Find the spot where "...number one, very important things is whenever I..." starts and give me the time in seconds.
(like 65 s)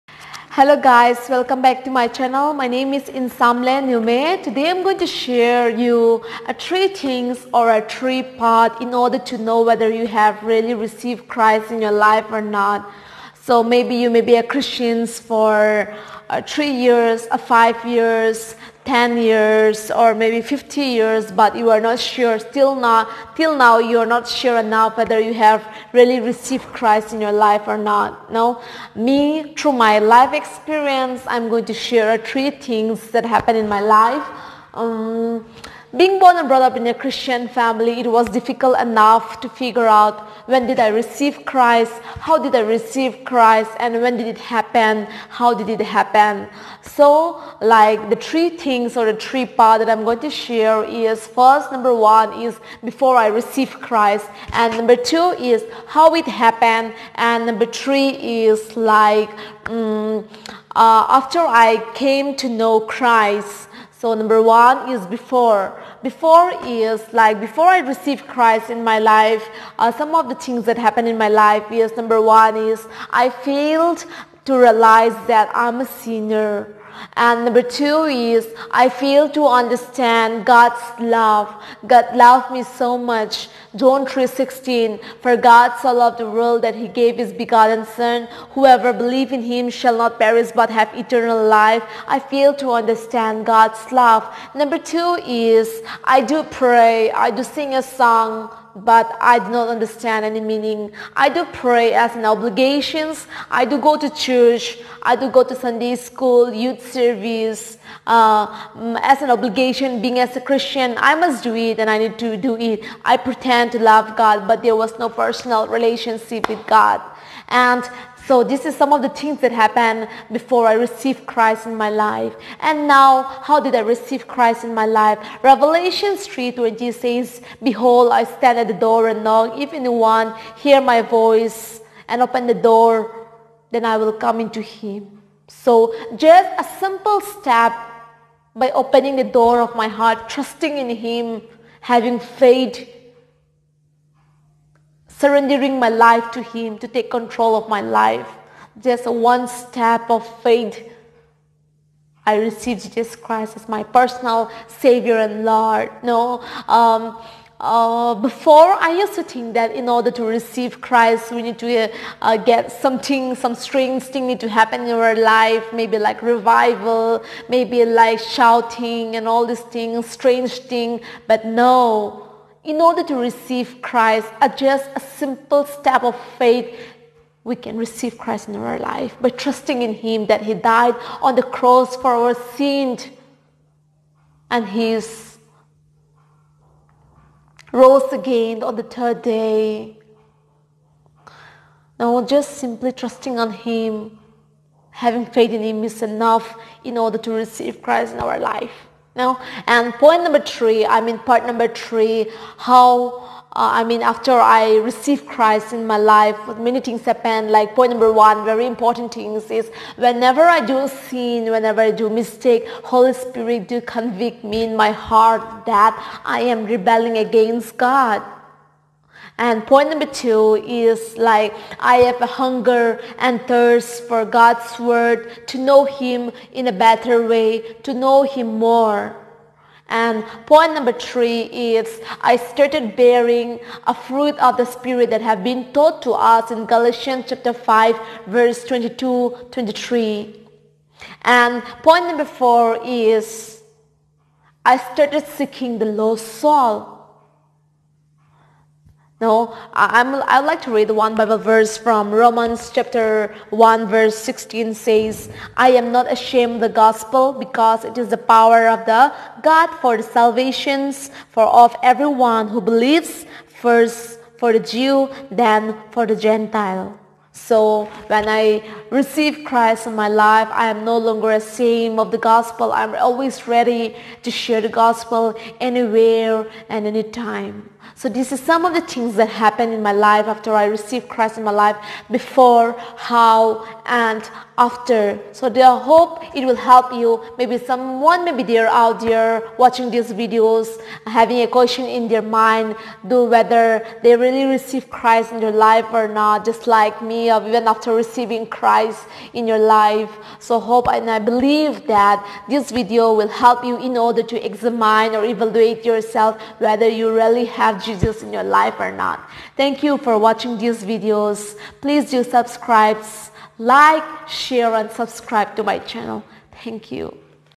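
207 s.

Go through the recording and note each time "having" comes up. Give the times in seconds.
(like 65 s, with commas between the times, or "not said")
141 s, 194 s, 291 s.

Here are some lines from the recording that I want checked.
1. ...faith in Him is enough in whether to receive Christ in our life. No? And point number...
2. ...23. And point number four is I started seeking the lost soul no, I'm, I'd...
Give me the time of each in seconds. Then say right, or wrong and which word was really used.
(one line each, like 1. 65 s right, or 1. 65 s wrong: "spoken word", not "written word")
1. 195 s wrong: "order", not "whether"
2. 239 s right.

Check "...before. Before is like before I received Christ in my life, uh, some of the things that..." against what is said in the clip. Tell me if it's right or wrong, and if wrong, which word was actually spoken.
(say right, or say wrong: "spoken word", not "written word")
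right.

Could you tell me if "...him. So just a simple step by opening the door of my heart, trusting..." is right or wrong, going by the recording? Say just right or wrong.
right.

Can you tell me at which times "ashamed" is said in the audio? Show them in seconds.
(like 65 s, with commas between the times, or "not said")
256 s, 271 s.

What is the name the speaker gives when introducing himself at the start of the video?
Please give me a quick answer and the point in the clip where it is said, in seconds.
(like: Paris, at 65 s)
Insamle Newme, at 3 s.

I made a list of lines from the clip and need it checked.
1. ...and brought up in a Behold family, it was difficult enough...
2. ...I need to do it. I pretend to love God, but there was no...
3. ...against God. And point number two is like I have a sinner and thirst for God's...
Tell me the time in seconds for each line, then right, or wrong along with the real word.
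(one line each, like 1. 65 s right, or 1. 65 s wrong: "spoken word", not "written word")
1. 36 s wrong: "Christian", not "Behold"
2. 111 s right
3. 217 s wrong: "hunger", not "sinner".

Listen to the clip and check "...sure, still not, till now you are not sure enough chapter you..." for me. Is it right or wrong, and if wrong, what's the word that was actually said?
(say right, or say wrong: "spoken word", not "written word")
wrong: "whether", not "chapter".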